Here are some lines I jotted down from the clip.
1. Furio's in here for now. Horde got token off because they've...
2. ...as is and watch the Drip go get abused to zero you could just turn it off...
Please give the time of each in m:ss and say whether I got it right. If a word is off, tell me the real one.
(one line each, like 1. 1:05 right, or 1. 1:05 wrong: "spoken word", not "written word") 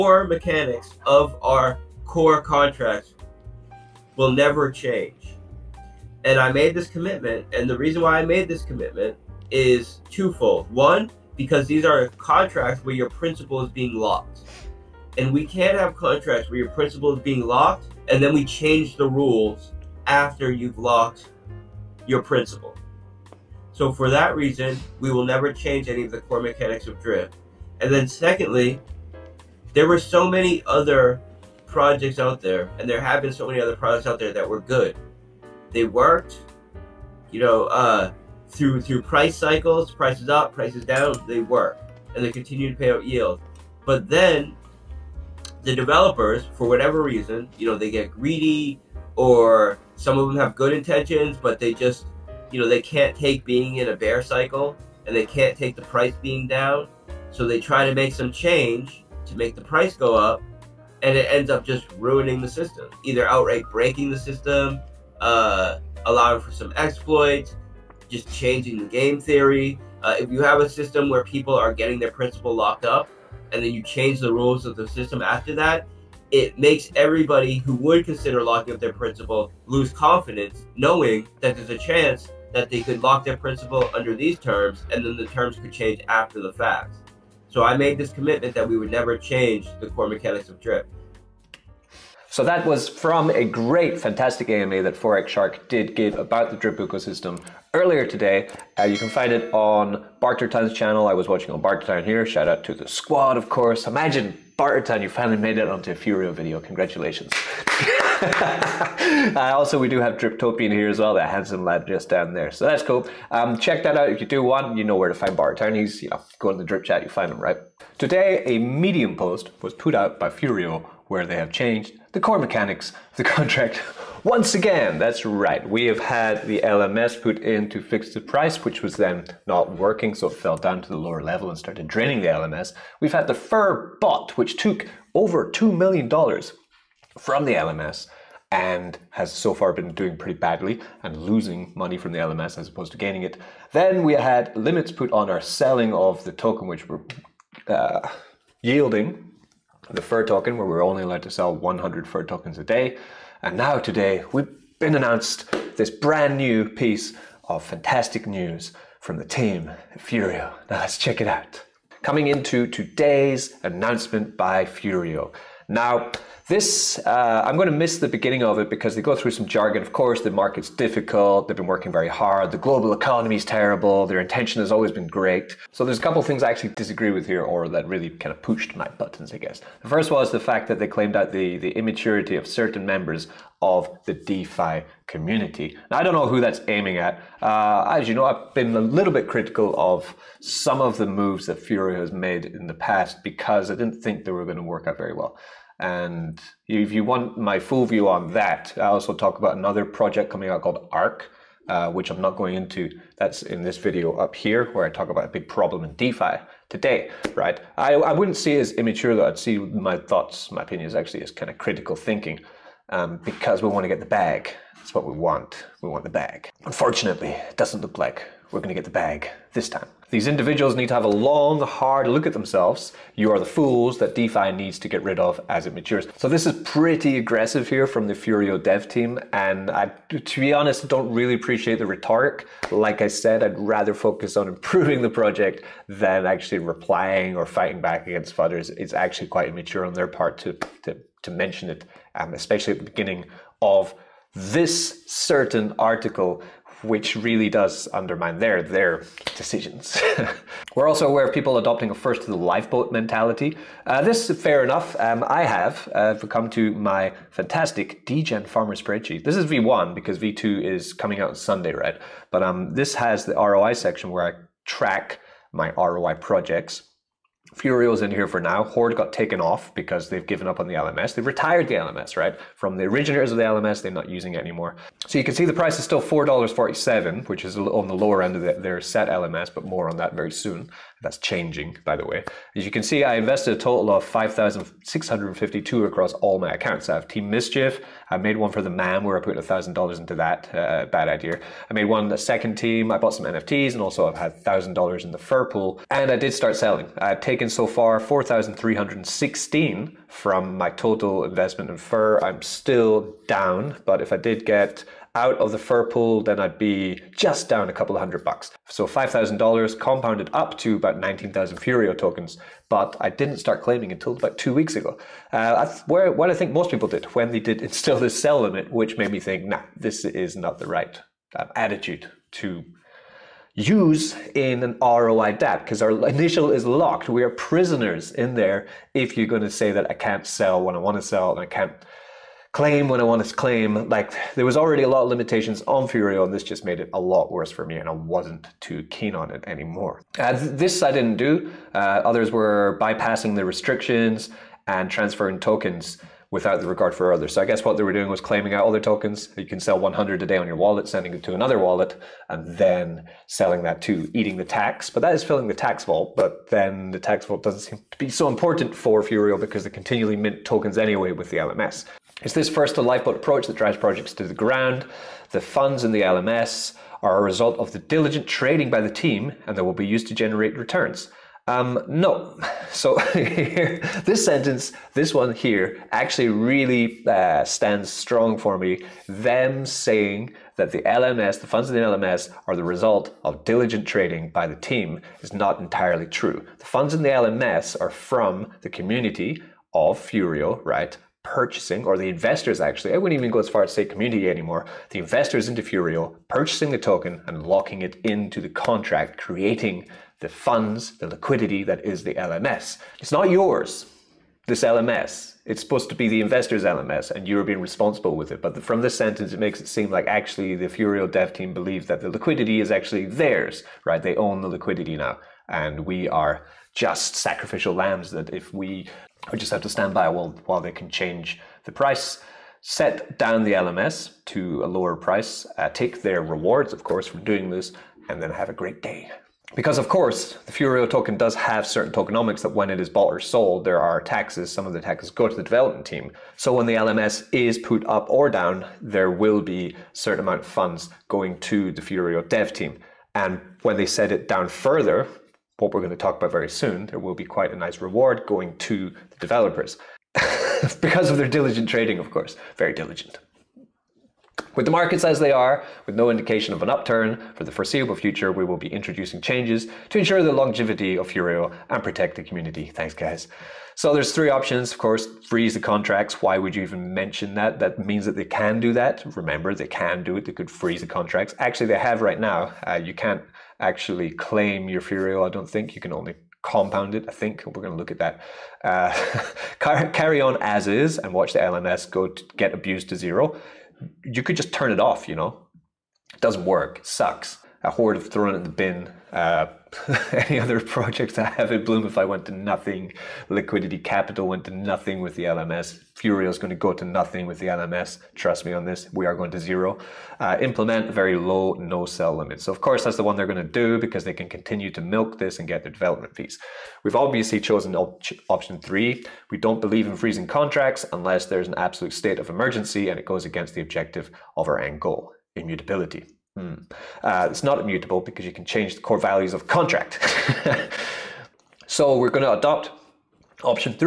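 1. 4:27 wrong: "taken", not "token"
2. 8:00 wrong: "LMS", not "Drip".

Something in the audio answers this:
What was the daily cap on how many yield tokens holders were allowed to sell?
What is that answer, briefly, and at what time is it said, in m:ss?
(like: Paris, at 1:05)
100, at 2:31.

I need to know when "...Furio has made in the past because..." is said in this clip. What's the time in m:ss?
3:11.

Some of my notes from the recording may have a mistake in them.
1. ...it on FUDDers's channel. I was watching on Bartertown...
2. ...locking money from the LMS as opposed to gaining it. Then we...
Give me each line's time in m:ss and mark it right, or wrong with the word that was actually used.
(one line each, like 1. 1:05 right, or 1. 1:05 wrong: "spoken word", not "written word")
1. 1:39 wrong: "Bartertown", not "FUDDers"
2. 2:21 wrong: "losing", not "locking".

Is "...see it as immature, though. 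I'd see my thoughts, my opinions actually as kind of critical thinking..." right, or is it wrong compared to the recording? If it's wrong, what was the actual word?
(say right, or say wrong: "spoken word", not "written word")
right.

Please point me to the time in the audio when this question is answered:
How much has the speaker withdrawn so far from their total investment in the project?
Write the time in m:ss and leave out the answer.
4:57.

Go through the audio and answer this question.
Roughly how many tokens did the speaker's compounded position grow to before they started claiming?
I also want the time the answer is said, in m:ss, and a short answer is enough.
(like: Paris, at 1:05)
About 19,000, at 5:10.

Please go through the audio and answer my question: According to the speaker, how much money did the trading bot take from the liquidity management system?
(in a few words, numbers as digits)
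Over $2 million.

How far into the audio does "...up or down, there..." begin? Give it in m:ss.
7:17.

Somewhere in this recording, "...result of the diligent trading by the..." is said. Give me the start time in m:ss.
6:07.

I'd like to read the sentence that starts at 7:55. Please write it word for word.
You can only compound it, I think.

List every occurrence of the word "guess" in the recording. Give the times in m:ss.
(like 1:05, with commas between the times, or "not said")
2:59, 5:47.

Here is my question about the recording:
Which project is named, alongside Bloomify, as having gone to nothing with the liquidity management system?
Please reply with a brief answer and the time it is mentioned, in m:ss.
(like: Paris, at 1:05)
Liquidity Capital, at 8:13.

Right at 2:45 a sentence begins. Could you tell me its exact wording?
Now, this, uh, I'm going to miss the beginning of it because they go through some jargon.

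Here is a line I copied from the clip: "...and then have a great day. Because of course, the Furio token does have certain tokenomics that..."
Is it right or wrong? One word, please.
right.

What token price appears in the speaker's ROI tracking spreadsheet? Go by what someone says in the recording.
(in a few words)
$4.47.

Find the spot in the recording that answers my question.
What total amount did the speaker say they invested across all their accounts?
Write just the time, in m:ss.
4:44.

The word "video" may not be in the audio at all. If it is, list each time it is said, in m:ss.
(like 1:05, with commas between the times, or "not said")
1:46, 3:23.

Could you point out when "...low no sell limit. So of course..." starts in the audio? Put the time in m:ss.
8:21.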